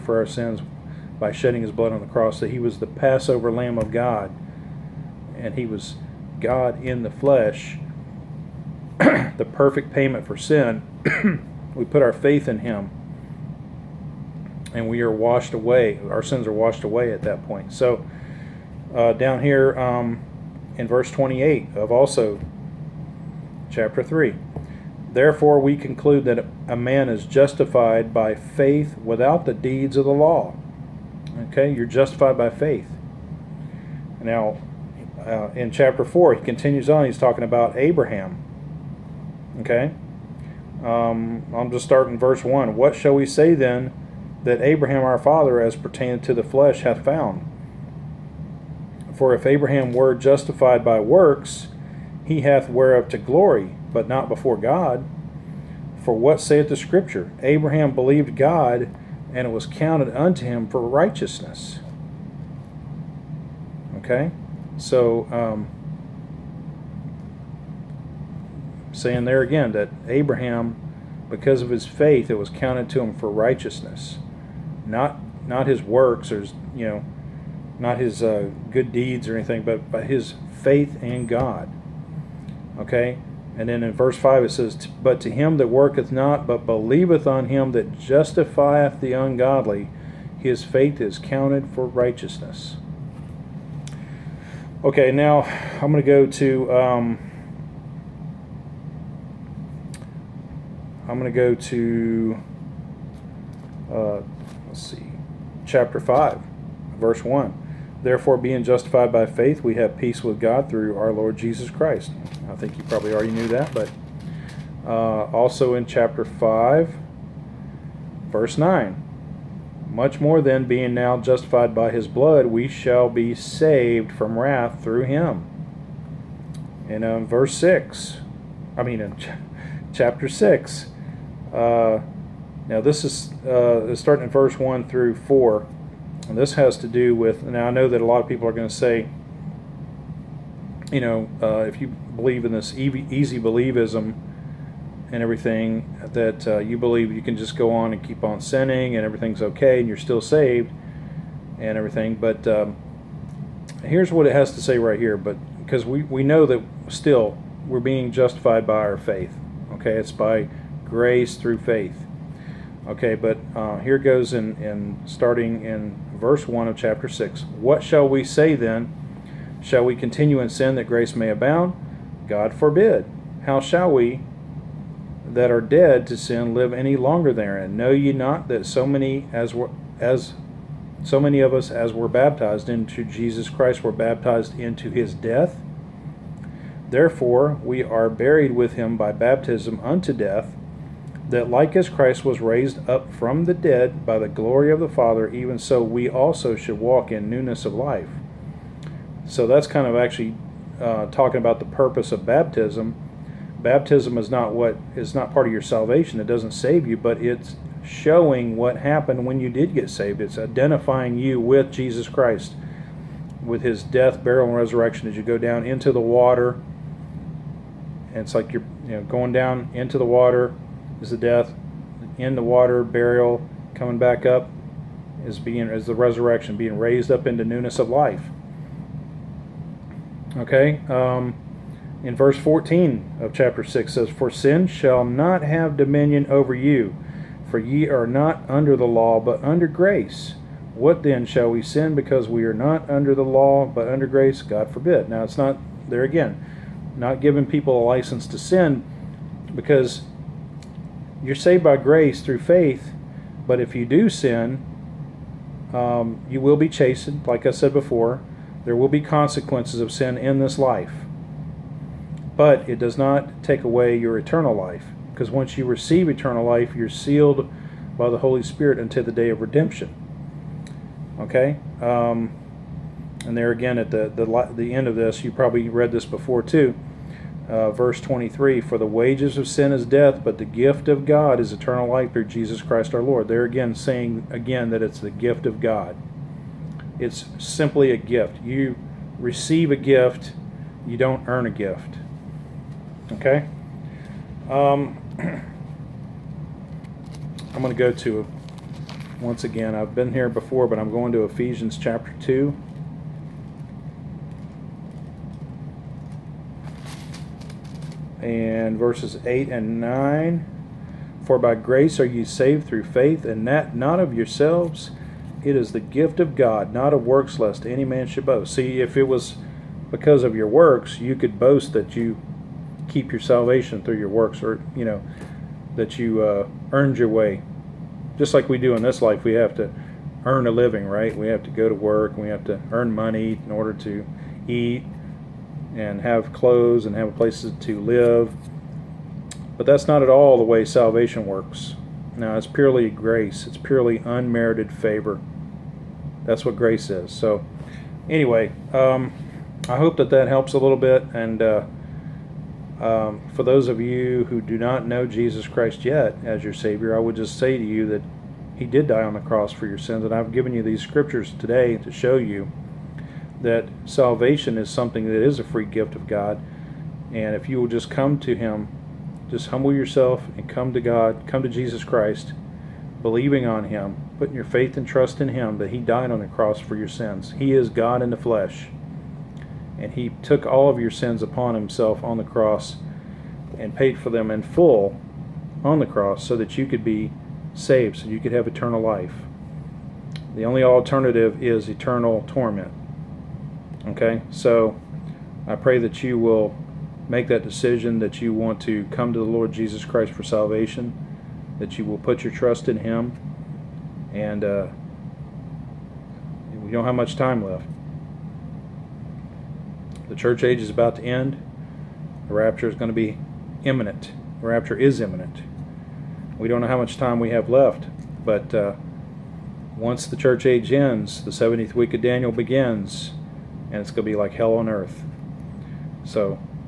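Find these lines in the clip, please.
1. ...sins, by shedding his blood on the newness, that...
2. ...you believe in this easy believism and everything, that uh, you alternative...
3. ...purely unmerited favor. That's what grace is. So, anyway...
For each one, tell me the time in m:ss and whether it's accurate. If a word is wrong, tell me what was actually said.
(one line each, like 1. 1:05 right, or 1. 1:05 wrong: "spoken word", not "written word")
1. 0:00 wrong: "cross", not "newness"
2. 2:21 wrong: "believe", not "alternative"
3. 5:43 right.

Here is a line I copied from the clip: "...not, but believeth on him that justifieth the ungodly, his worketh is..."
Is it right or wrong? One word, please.
wrong.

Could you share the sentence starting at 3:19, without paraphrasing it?
So that's kind of actually uh, talking about the purpose of baptism.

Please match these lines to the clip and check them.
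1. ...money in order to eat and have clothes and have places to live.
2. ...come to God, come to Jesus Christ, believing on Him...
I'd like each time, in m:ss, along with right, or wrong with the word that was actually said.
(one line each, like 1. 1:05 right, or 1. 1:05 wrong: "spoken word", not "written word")
1. 5:32 right
2. 6:10 right.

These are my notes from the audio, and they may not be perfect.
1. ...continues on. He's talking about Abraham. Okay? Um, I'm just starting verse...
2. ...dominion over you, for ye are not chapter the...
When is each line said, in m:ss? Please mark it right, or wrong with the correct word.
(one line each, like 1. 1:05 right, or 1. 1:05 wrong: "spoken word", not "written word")
1. 0:36 right
2. 3:55 wrong: "under", not "chapter".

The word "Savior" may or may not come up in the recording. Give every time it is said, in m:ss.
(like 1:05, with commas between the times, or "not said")
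5:56.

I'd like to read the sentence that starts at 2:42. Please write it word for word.
Okay, but uh, here goes in, in starting in verse 1 of chapter 6.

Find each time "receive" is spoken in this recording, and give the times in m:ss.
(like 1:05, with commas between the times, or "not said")
4:25, 4:49.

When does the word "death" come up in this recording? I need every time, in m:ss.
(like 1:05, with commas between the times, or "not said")
3:05, 3:10, 3:33, 3:41, 4:39.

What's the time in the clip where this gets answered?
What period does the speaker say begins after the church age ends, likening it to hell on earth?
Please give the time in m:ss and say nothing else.
7:01.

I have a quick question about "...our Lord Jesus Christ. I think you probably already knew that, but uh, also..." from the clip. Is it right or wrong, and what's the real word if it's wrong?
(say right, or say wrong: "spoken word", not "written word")
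right.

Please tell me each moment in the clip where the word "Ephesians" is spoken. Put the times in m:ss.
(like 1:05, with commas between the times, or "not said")
5:01.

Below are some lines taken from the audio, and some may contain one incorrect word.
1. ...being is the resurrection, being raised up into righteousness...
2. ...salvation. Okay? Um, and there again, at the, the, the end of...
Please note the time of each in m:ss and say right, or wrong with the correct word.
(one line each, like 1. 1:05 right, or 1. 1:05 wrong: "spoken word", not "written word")
1. 3:45 wrong: "newness", not "righteousness"
2. 4:29 wrong: "redemption", not "salvation".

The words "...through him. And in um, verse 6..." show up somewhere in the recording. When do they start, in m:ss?
2:04.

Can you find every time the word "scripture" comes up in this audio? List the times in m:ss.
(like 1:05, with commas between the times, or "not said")
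0:56, 6:00.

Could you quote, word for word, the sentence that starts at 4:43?
They're again saying again that it's the gift of God.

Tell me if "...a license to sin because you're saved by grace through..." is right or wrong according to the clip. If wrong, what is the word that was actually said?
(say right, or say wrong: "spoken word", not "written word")
right.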